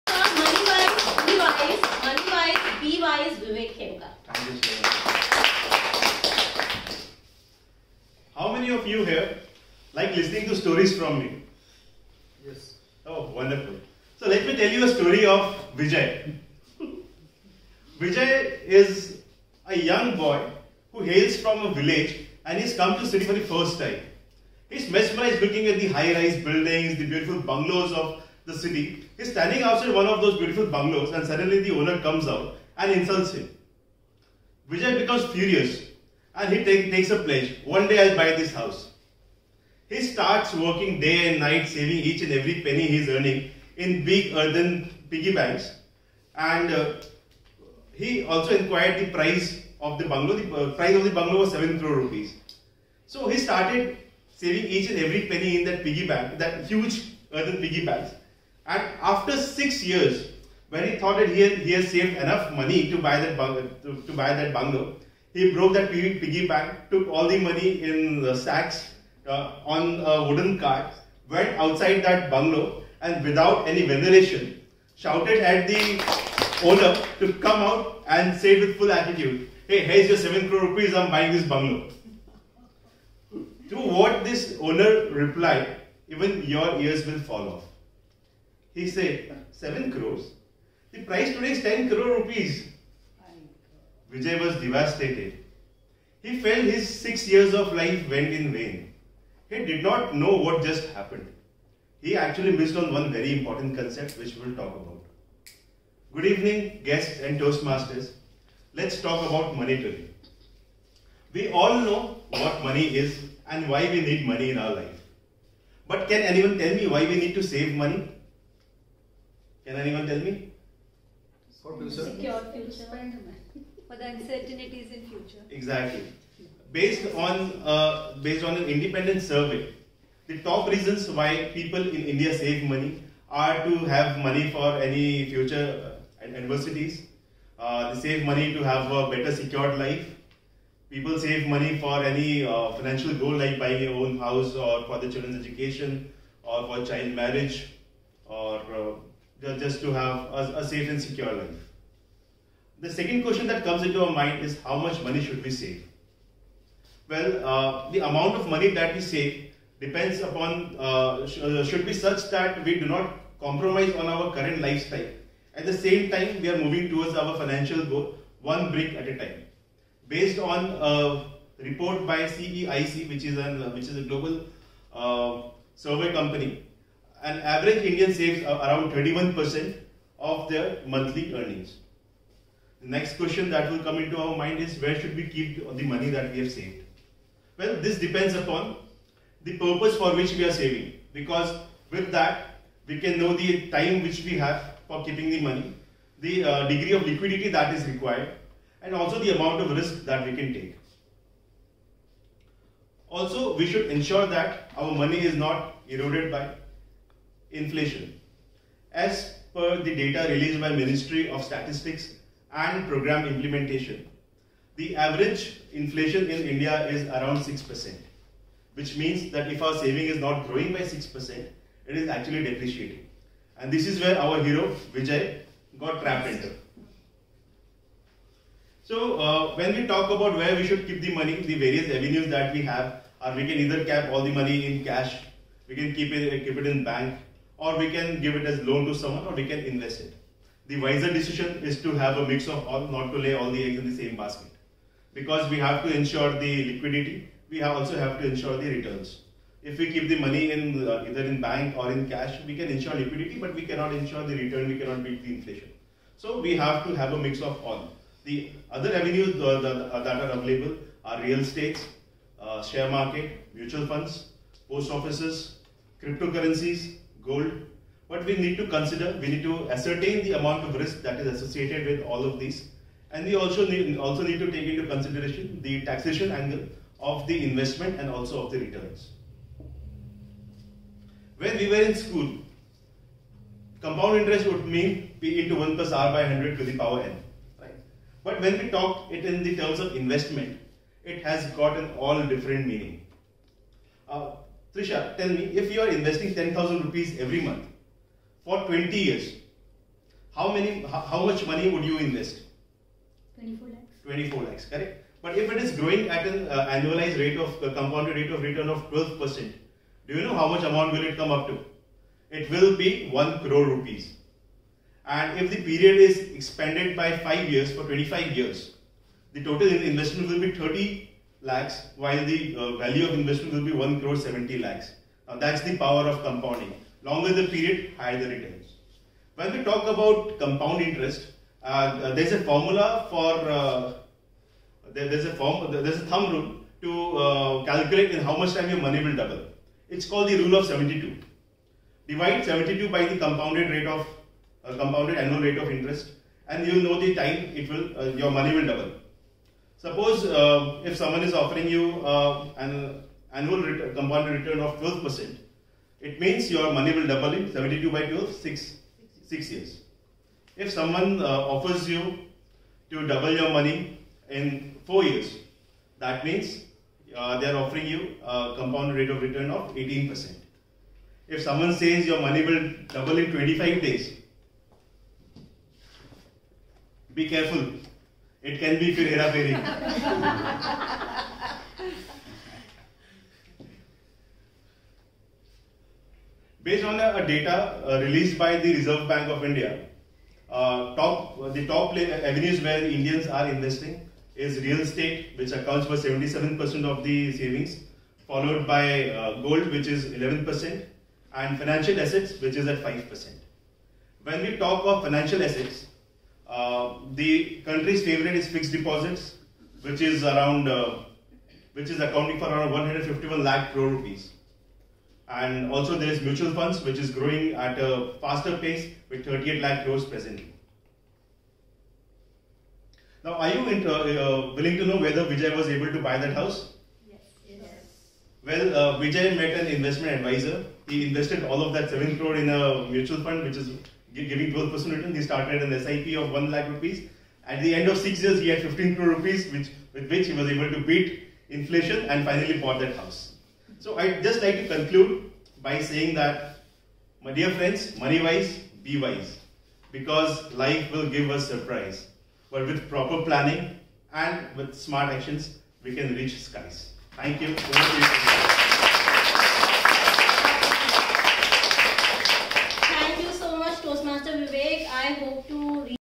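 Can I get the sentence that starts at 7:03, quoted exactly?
Now, are you uh, uh, willing to know whether Vijay was able to buy that house?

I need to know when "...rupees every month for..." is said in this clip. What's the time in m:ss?
4:56.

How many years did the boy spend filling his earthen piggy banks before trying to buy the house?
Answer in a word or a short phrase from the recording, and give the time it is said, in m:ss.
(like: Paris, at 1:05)
6, at 0:59.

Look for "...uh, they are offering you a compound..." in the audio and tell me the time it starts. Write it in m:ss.
6:07.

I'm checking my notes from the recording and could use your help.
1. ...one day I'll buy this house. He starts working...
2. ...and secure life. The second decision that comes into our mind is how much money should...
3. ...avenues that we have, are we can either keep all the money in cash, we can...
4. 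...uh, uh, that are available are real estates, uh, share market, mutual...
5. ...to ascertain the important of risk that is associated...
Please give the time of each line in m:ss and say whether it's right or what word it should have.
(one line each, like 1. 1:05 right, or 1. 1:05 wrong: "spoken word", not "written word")
1. 0:37 right
2. 2:30 wrong: "question", not "decision"
3. 3:51 right
4. 4:19 right
5. 4:29 wrong: "amount", not "important".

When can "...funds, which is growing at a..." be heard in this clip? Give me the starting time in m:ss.
6:56.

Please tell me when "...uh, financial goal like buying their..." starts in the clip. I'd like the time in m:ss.
2:22.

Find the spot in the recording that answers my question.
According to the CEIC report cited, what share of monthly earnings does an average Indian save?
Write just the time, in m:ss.
2:58.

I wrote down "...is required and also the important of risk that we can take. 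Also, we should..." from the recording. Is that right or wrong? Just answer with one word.
wrong.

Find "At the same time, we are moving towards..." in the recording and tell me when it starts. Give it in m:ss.
2:45.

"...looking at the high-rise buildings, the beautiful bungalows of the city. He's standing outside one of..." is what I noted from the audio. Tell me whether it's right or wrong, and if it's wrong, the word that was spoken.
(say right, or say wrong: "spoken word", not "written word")
right.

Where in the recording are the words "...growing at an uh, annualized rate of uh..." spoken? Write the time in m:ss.
5:05.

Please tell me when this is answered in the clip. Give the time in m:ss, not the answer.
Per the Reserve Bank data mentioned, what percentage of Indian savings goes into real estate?
6:35.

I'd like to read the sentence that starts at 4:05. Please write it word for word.
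Because we have to ensure the liquidity, we also have to ensure the returns.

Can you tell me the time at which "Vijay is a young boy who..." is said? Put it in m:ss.
0:18.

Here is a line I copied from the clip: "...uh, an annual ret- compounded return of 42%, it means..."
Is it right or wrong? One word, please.
wrong.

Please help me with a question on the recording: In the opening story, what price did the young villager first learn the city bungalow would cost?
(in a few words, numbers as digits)
7 crore rupees.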